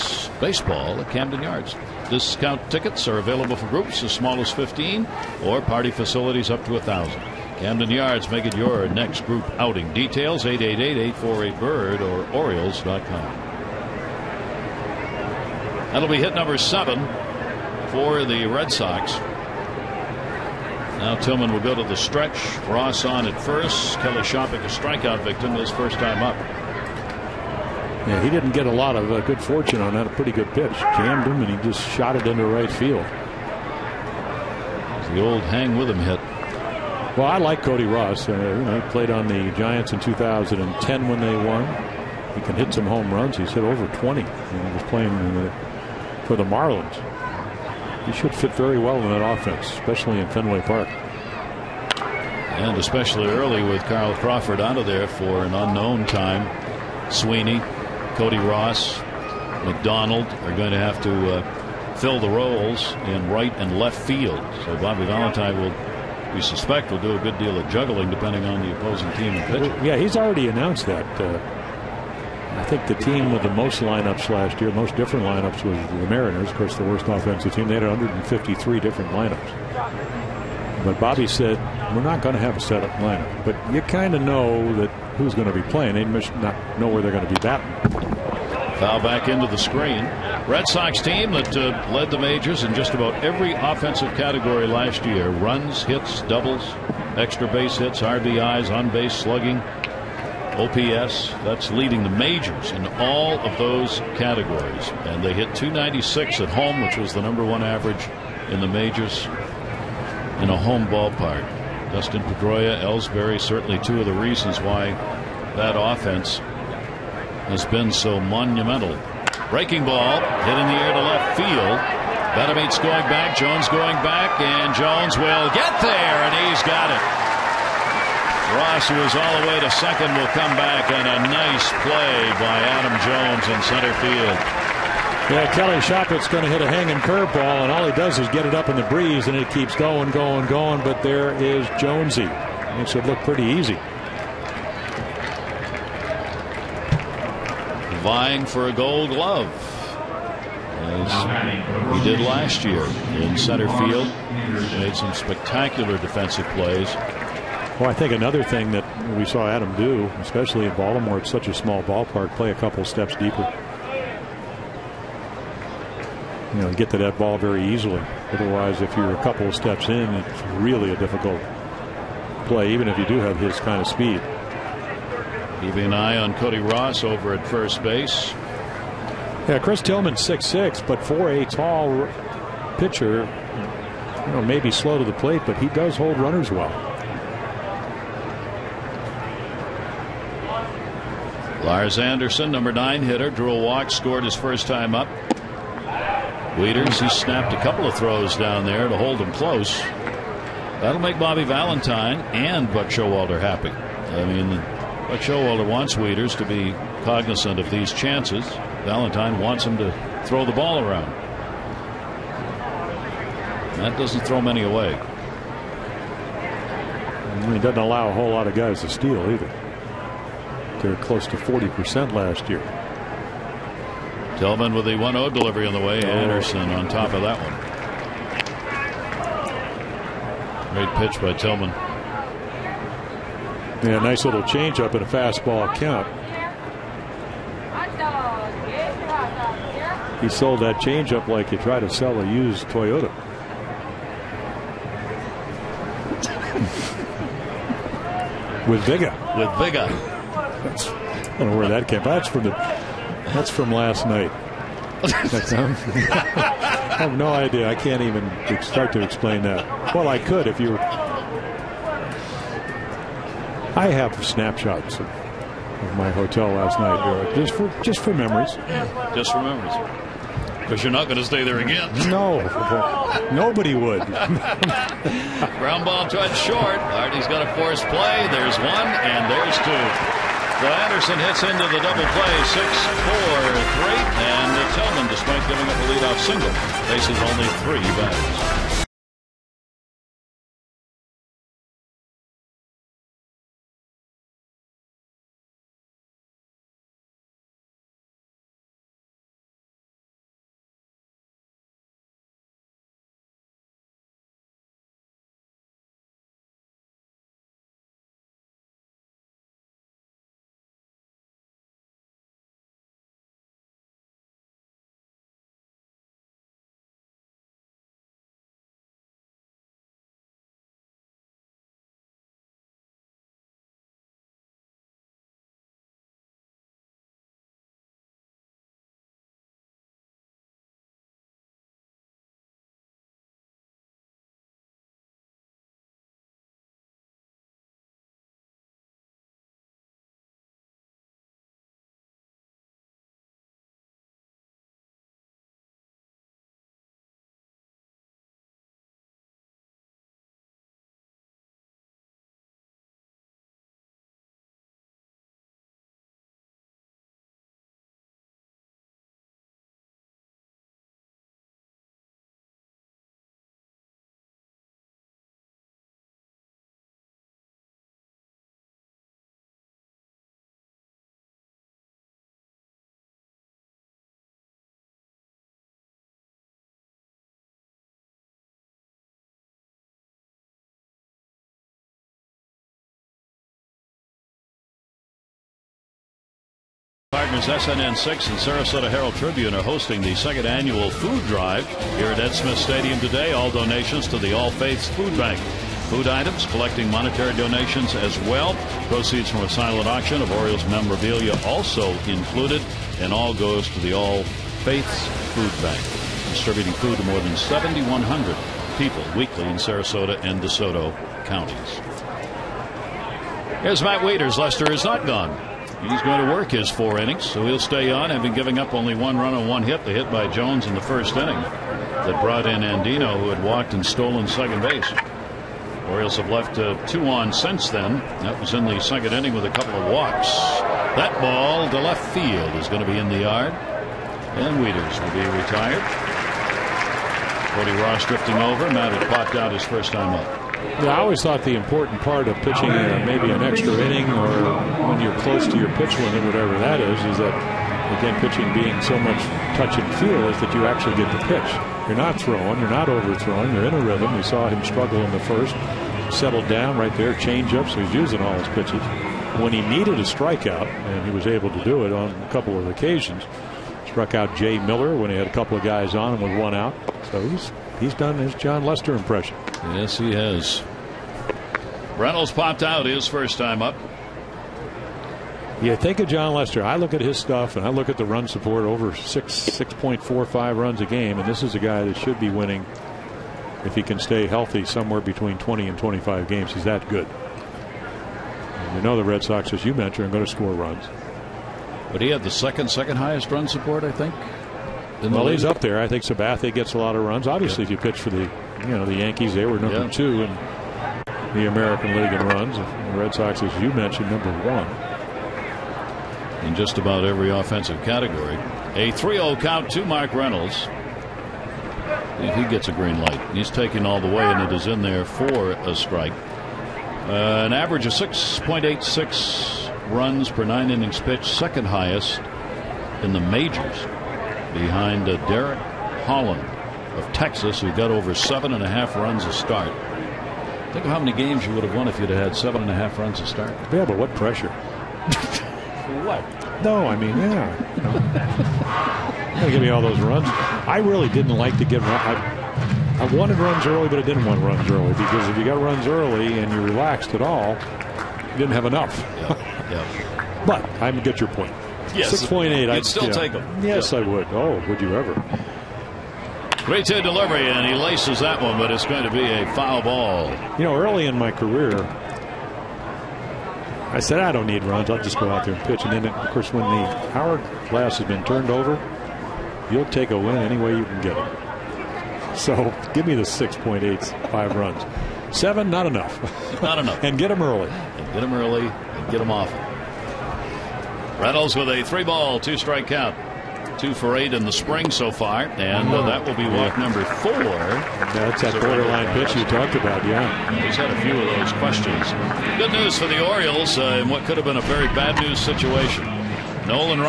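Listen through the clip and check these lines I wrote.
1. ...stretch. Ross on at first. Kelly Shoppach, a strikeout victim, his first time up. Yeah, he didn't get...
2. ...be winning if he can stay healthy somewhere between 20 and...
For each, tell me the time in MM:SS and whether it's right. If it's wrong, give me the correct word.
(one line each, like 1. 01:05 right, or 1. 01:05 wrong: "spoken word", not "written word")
1. 00:21 right
2. 08:02 right.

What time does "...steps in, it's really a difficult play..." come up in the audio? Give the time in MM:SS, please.
02:49.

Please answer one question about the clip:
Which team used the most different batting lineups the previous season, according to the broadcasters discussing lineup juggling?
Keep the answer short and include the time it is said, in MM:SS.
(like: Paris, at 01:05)
Mariners, at 01:16.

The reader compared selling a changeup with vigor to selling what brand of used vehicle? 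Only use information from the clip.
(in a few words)
Toyota.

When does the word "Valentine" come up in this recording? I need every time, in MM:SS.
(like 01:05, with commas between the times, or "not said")
01:05, 03:21, 03:28.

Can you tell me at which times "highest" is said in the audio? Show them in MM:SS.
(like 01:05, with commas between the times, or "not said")
08:12, 08:41.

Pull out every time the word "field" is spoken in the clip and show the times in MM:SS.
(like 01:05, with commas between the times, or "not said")
00:32, 01:03, 02:01, 02:14, 02:33, 07:12.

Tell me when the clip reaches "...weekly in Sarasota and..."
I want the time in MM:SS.
06:49.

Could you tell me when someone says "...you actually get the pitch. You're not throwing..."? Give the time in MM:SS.
07:30.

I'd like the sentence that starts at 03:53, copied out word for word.
Yeah, nice little changeup and a fastball count.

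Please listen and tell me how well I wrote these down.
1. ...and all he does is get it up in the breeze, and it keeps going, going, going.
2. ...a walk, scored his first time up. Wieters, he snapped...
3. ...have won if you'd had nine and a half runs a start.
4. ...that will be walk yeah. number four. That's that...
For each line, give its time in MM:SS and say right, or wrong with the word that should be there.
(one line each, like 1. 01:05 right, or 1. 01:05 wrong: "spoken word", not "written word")
1. 02:17 right
2. 03:13 right
3. 08:51 wrong: "seven", not "nine"
4. 09:46 right.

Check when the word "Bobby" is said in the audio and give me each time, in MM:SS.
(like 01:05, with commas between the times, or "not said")
01:04, 01:20, 03:21.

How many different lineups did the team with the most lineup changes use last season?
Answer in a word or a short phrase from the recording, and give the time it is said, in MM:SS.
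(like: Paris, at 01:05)
153, at 01:17.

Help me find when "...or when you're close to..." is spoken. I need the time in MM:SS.
07:24.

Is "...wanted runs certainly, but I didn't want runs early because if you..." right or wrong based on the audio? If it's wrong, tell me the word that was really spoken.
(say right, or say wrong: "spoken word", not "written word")
wrong: "early", not "certainly".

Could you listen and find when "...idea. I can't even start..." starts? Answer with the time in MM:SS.
04:17.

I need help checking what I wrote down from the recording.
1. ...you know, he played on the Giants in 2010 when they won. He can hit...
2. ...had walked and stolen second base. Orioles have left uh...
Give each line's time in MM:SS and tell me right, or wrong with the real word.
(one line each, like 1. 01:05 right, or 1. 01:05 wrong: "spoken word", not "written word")
1. 00:38 right
2. 07:03 right.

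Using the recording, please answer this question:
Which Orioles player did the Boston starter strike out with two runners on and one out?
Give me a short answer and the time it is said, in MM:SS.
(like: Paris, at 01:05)
Jai Miller, at 07:44.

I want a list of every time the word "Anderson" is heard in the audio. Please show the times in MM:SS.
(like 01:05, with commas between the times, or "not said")
03:11, 03:46, 04:40.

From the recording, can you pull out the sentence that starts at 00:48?
He should fit very well in that offense, especially in Fenway Park.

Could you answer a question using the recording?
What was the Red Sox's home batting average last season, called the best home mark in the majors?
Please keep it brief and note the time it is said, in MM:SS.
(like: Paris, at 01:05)
296, at 01:45.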